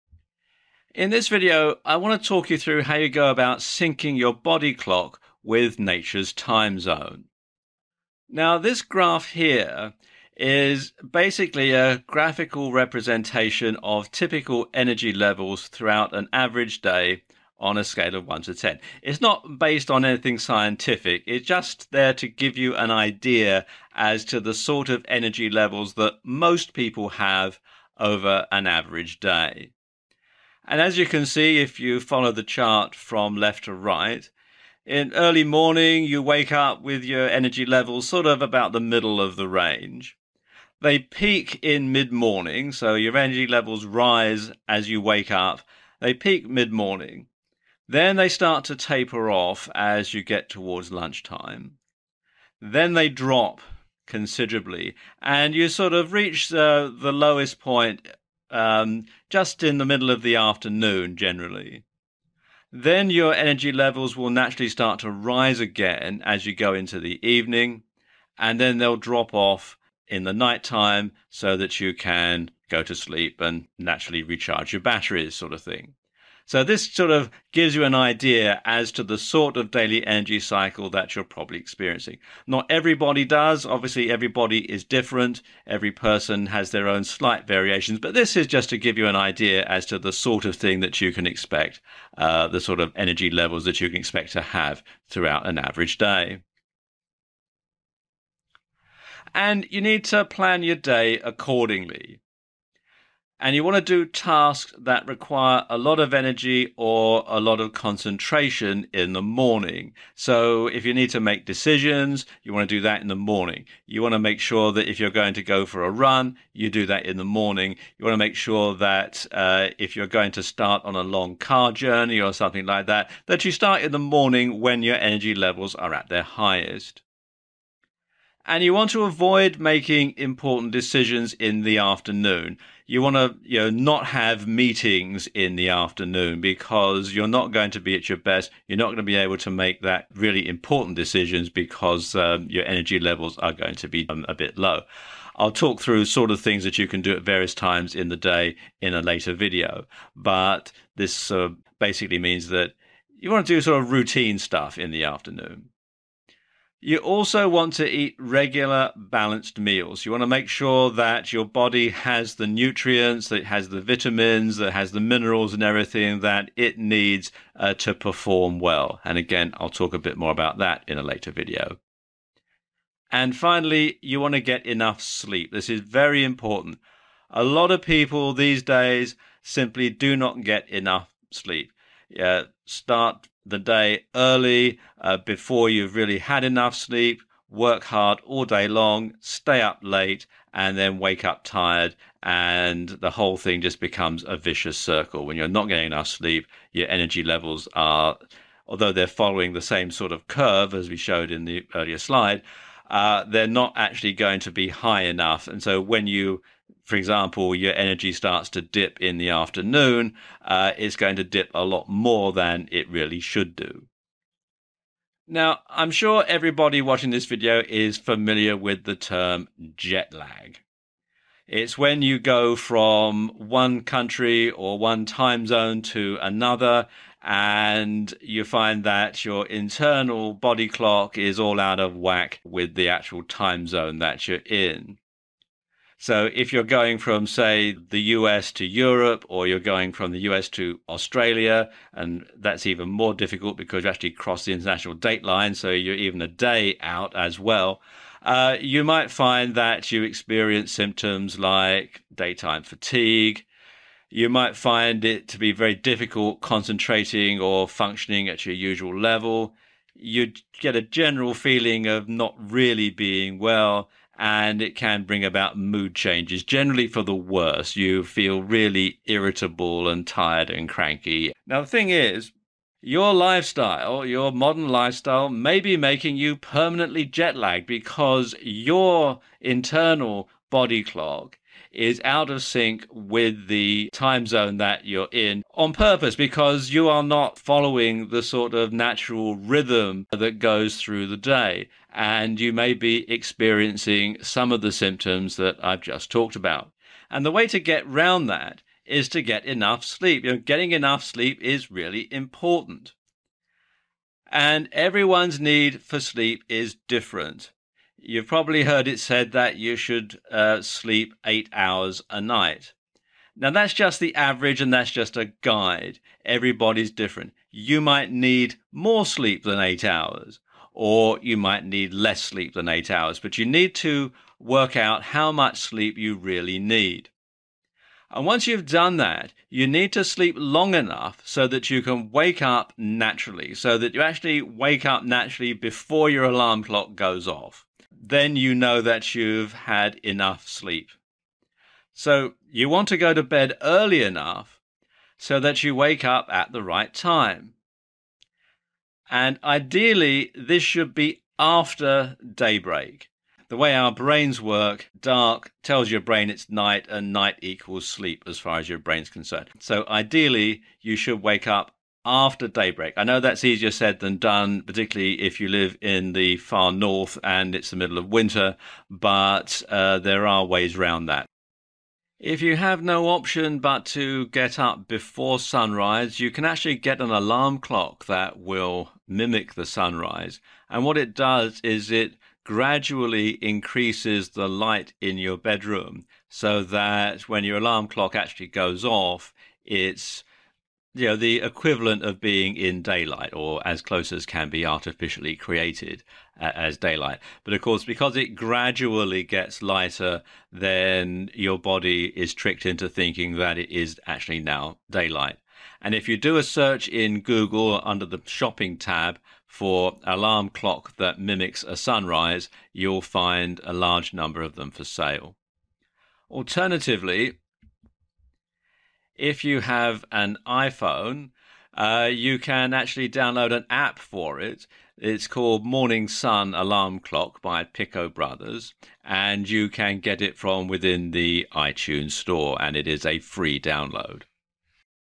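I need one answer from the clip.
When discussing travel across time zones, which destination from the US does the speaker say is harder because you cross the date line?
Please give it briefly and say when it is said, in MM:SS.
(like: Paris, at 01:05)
Australia, at 04:00.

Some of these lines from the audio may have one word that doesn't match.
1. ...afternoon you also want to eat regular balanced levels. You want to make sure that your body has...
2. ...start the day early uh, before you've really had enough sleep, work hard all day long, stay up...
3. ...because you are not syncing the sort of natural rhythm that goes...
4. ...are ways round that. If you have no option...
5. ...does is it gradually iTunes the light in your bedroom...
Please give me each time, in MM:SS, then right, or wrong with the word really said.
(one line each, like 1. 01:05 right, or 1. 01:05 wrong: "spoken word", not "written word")
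1. 02:35 wrong: "meals", not "levels"
2. 03:02 right
3. 04:46 wrong: "following", not "syncing"
4. 06:10 right
5. 06:21 wrong: "increases", not "iTunes".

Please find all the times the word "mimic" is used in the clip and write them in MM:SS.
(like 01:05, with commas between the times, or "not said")
06:19, 06:51.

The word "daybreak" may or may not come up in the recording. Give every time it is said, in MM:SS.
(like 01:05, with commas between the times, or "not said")
05:52, 06:02.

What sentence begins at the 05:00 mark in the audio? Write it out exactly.
You know, getting enough sleep is really important.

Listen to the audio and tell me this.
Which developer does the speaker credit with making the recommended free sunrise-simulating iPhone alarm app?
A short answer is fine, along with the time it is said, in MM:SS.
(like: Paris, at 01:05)
Pico Brothers, at 07:07.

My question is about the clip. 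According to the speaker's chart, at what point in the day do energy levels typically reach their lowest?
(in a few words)
Middle of the afternoon.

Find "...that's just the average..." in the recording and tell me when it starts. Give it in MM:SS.
05:13.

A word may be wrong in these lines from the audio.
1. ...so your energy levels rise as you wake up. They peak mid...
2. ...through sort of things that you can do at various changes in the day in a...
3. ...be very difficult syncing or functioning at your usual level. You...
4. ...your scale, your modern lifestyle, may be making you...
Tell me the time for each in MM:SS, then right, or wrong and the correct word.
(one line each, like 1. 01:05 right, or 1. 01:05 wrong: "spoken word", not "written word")
1. 00:42 right
2. 02:25 wrong: "times", not "changes"
3. 04:15 wrong: "concentrating", not "syncing"
4. 04:32 wrong: "lifestyle", not "scale".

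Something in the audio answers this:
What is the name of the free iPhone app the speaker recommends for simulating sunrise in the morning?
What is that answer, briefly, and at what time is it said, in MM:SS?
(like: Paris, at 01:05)
Morning Sun Alarm Clock, at 07:05.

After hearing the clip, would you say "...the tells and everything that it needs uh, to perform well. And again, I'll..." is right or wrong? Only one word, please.
wrong.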